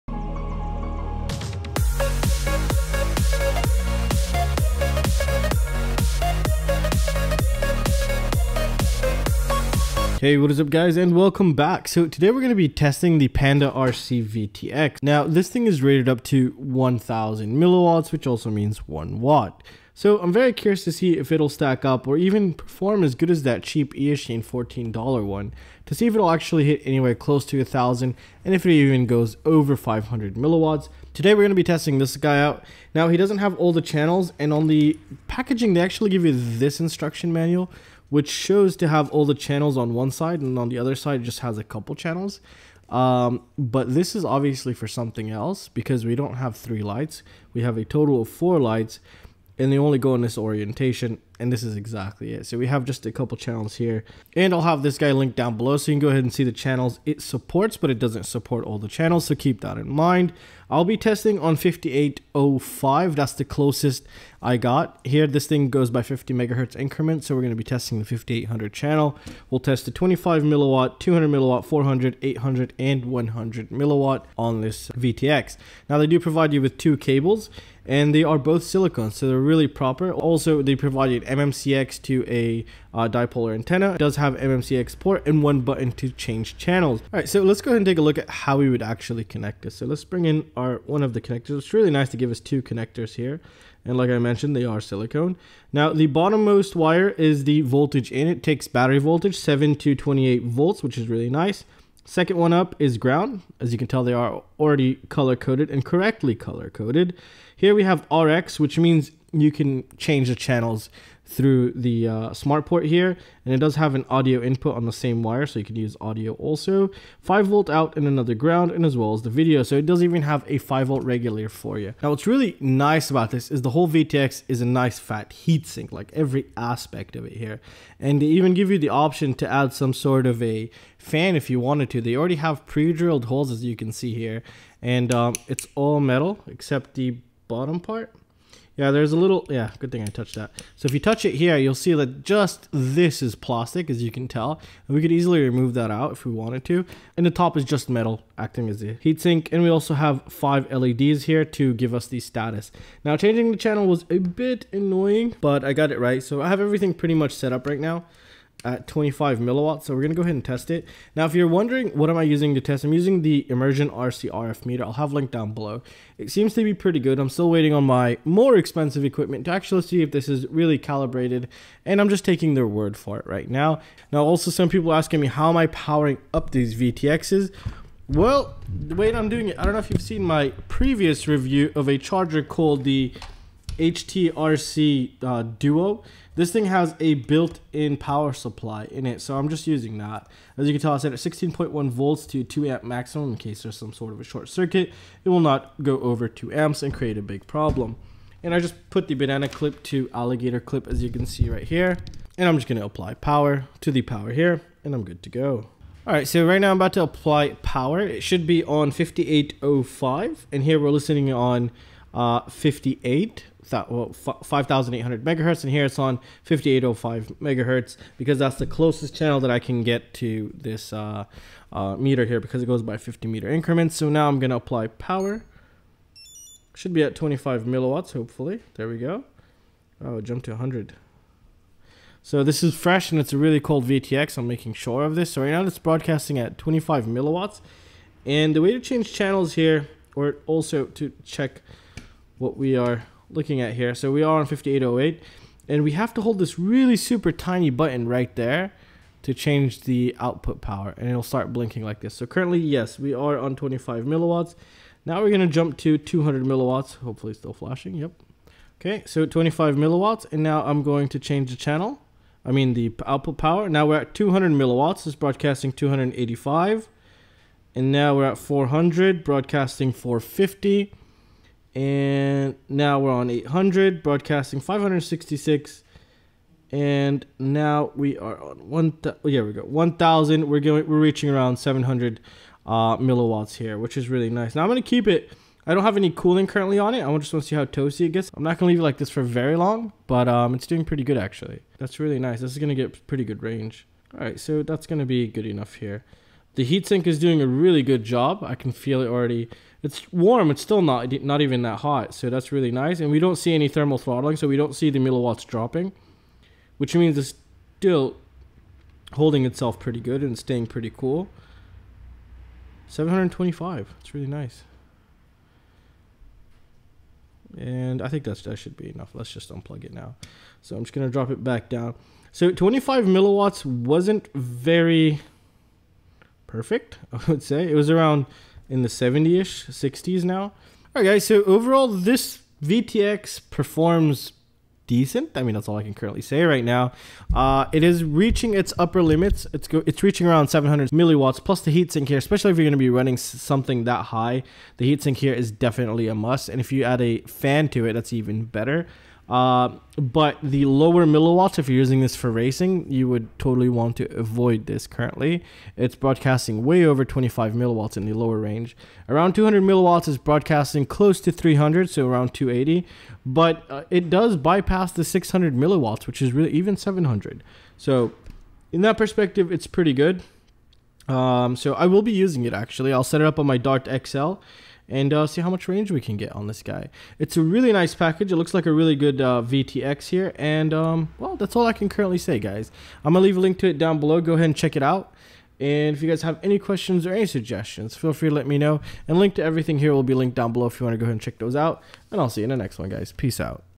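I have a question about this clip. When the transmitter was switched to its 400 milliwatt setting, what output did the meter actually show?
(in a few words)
450.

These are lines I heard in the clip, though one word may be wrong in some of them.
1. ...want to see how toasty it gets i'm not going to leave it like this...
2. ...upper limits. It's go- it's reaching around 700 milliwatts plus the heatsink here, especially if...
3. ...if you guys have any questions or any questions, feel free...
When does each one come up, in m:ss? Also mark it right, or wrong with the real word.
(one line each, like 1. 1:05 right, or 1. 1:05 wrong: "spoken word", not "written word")
1. 4:47 right
2. 5:38 right
3. 6:25 wrong: "suggestions", not "questions".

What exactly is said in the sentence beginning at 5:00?
It's still not not even that hot, so that's really nice.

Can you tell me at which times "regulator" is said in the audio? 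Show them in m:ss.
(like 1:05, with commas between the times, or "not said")
2:01.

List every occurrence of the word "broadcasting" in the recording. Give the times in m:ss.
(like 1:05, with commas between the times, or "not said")
3:55, 4:25, 4:29, 4:34, 5:55, 6:00.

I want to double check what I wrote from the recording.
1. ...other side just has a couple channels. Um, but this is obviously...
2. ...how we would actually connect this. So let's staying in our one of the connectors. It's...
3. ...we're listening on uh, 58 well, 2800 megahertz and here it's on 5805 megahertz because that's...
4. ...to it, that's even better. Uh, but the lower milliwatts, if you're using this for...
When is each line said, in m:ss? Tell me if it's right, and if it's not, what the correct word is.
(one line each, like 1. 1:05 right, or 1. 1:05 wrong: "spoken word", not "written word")
1. 0:40 right
2. 1:28 wrong: "bring", not "staying"
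3. 3:30 wrong: "5800", not "2800"
4. 5:47 right.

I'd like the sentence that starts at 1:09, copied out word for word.
We'll test the 25 milliwatt, 200 milliwatt, 400, 800 and 100 milliwatt on this VTX.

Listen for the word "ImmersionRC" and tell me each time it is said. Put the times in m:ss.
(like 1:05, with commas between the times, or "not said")
2:43.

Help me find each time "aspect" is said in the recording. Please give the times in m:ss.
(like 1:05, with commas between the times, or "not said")
2:06.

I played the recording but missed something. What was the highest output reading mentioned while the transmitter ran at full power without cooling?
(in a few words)
725.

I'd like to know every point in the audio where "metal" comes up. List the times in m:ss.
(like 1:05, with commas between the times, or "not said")
2:16, 2:27.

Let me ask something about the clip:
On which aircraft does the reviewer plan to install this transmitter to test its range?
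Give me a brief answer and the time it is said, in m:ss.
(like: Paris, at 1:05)
Dart XL, at 6:13.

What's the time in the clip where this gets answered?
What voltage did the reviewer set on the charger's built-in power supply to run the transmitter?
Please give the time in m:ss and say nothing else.
3:11.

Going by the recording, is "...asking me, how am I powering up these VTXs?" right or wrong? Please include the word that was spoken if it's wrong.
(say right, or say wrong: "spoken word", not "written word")
right.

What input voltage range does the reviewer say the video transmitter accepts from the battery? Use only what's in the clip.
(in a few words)
7 to 28 volts.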